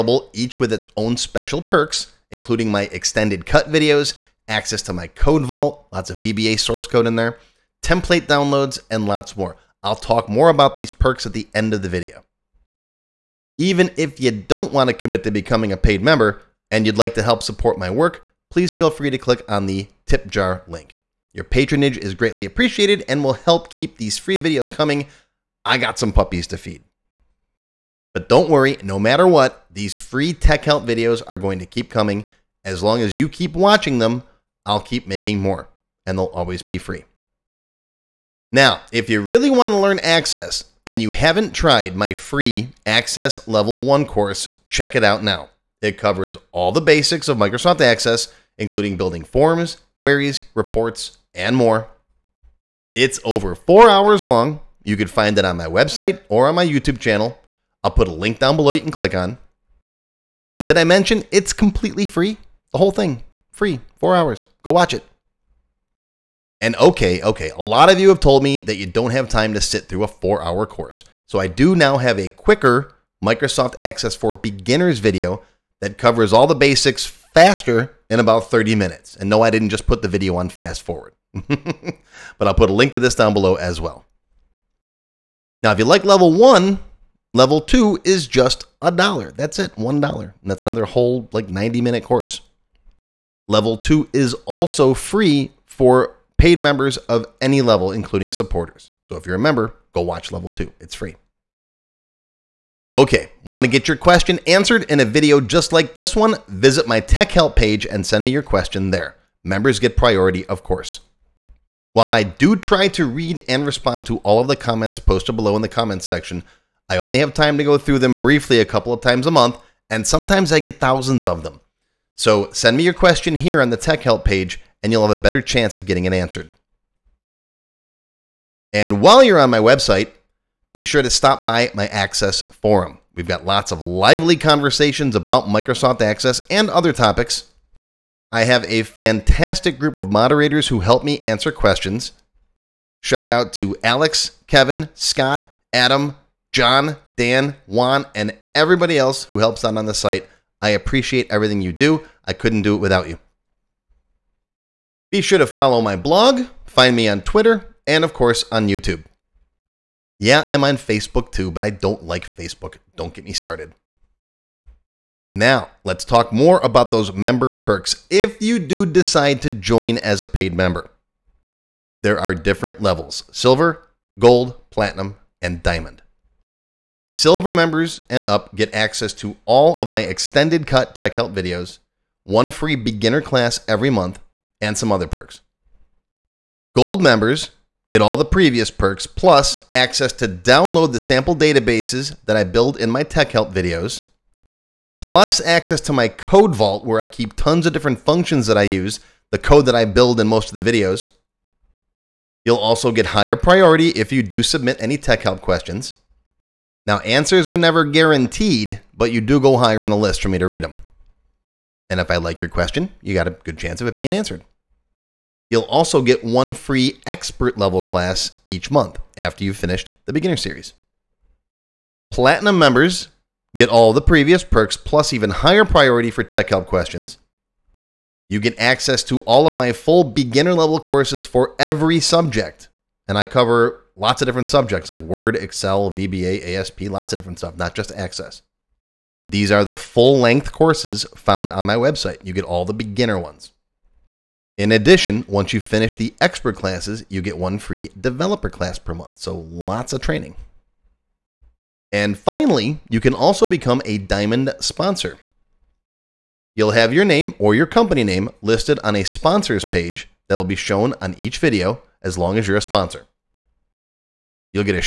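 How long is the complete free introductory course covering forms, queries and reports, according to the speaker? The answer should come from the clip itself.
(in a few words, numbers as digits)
over 4 hours.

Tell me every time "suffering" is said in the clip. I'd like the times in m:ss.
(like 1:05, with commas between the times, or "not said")
not said.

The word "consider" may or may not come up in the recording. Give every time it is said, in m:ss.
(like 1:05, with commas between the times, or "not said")
not said.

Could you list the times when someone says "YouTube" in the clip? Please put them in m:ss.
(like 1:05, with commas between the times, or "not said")
0:56, 2:38.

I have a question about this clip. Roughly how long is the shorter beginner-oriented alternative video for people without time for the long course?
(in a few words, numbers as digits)
30 minutes.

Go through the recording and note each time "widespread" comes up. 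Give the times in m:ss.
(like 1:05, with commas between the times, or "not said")
not said.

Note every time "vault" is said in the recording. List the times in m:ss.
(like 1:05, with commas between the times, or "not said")
0:05, 3:16.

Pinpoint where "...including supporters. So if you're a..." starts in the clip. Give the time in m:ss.
1:37.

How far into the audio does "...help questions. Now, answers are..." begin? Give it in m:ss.
3:25.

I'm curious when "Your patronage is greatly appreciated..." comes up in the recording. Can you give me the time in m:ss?
0:21.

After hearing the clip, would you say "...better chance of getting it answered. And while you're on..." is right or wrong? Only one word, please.
right.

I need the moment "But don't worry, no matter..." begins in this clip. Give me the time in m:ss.
0:28.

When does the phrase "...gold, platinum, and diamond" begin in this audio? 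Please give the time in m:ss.
2:54.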